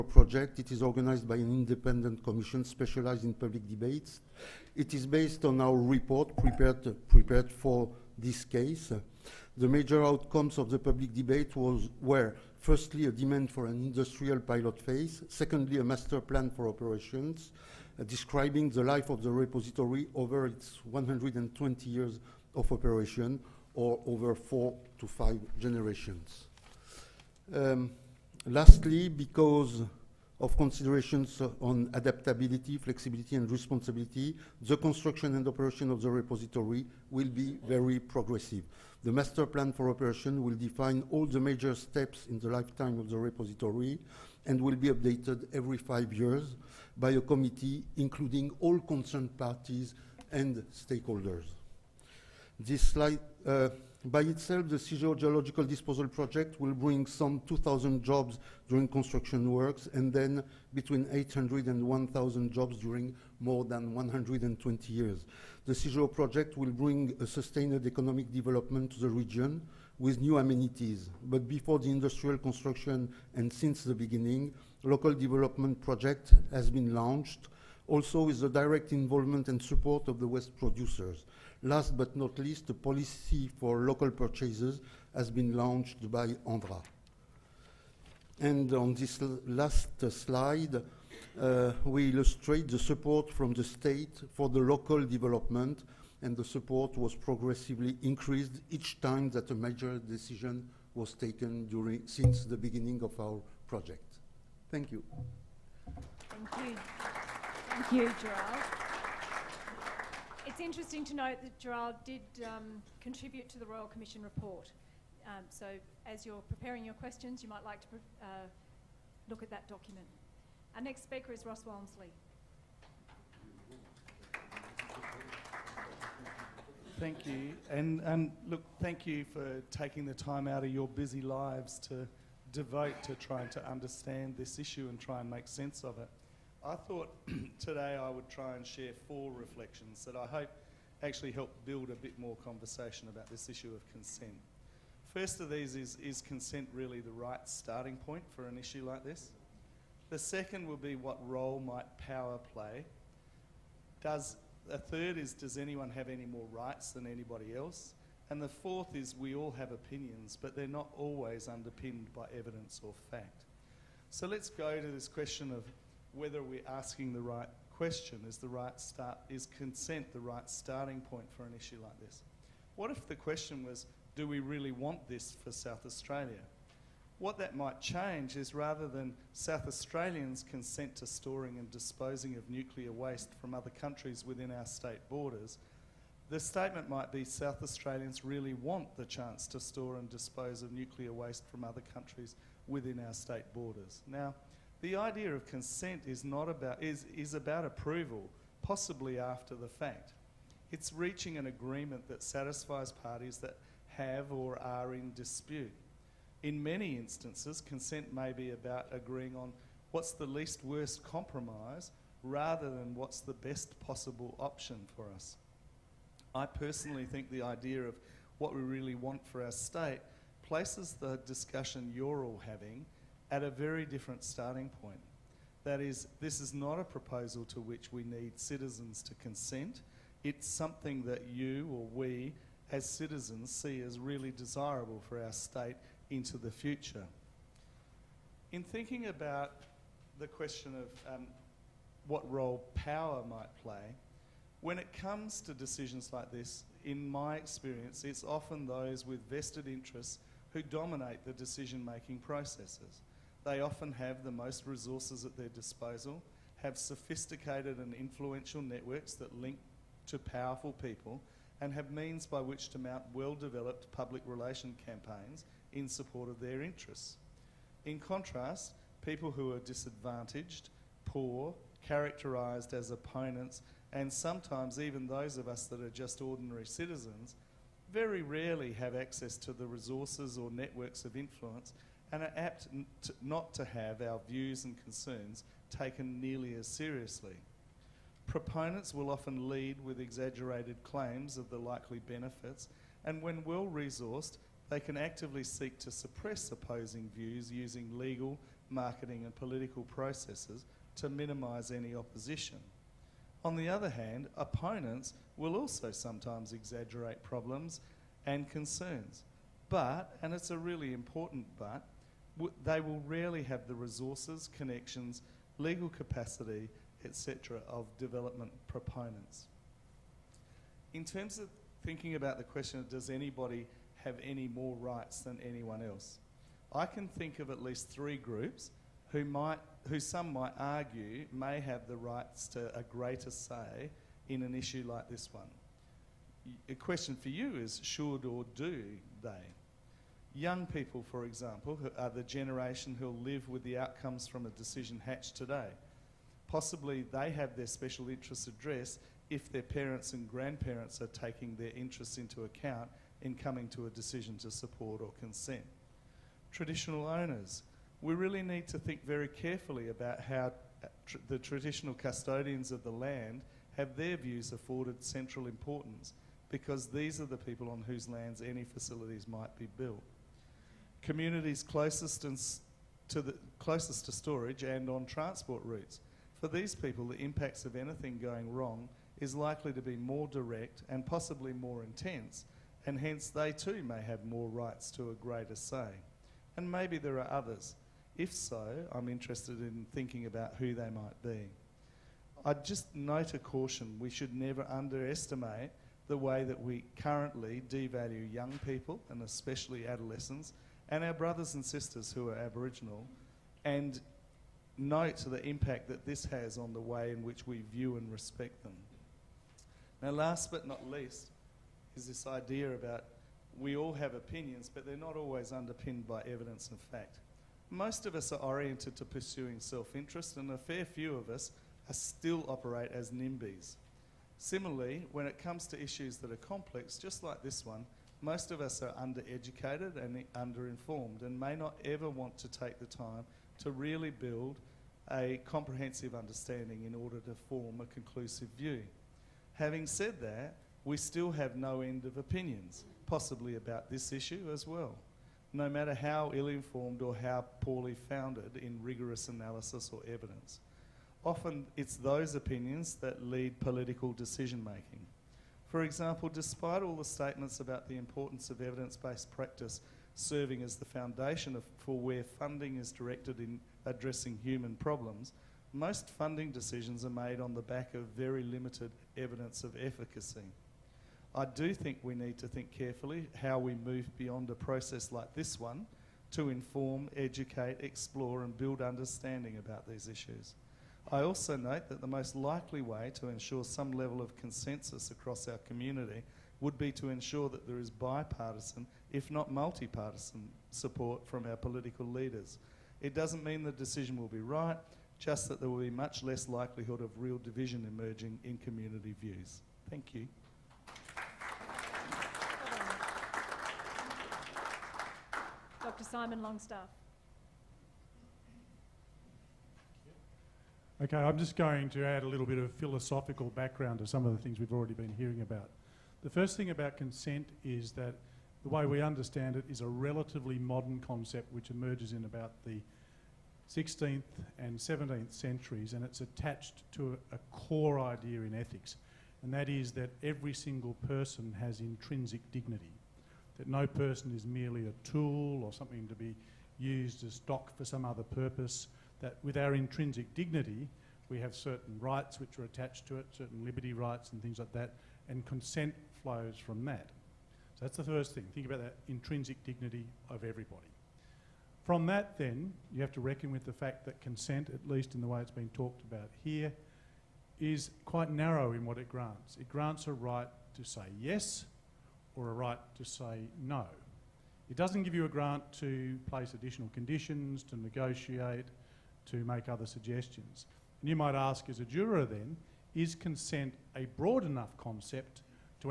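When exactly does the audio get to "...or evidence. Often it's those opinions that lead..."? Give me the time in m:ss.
7:29.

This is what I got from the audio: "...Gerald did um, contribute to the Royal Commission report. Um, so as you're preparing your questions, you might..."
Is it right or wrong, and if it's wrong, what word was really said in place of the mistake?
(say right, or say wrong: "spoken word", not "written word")
right.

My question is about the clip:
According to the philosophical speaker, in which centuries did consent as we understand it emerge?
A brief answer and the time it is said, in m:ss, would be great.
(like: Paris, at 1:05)
16th and 17th centuries, at 8:43.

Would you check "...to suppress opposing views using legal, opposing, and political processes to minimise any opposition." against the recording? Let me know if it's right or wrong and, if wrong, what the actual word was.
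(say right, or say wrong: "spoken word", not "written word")
wrong: "marketing", not "opposing".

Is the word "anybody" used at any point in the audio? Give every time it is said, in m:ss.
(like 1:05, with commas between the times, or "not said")
2:37, 5:23.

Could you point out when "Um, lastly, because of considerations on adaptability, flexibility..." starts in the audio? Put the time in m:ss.
0:27.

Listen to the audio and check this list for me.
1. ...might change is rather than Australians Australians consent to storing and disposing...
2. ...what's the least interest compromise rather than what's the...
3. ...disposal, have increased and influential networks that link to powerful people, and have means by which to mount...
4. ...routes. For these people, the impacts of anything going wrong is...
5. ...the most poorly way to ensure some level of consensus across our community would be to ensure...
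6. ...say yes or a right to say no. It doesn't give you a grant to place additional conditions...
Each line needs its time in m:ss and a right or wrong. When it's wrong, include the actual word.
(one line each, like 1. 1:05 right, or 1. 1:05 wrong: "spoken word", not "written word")
1. 2:57 wrong: "South", not "Australians"
2. 3:29 wrong: "worst", not "interest"
3. 4:15 wrong: "sophisticated", not "increased"
4. 6:15 right
5. 8:02 wrong: "likely", not "poorly"
6. 9:20 right.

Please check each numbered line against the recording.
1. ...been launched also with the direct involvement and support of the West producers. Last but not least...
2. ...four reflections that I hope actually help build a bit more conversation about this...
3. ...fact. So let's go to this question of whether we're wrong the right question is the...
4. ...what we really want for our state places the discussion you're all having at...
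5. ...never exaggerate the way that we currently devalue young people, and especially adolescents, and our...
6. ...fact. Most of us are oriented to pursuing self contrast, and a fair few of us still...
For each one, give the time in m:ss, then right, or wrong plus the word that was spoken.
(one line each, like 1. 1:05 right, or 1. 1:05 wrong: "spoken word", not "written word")
1. 1:16 right
2. 2:19 right
3. 2:43 wrong: "asking", not "wrong"
4. 3:38 right
5. 6:34 wrong: "underestimate", not "exaggerate"
6. 6:56 wrong: "interest", not "contrast".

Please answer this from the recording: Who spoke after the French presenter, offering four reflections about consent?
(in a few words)
Ross Womersley.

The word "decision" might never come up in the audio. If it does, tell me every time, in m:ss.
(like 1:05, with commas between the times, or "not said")
1:39, 4:05, 4:11, 5:44, 5:53, 7:34, 7:46, 8:13.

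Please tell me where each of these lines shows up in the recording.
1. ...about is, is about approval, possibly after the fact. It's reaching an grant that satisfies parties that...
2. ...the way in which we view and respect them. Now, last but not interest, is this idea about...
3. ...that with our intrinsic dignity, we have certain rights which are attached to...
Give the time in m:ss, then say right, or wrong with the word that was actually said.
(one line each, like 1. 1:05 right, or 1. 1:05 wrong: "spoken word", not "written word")
1. 3:16 wrong: "agreement", not "grant"
2. 6:46 wrong: "least", not "interest"
3. 8:59 right.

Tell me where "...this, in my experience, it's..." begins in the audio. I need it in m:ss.
4:06.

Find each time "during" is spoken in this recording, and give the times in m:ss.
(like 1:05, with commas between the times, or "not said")
0:58, 1:02, 1:41.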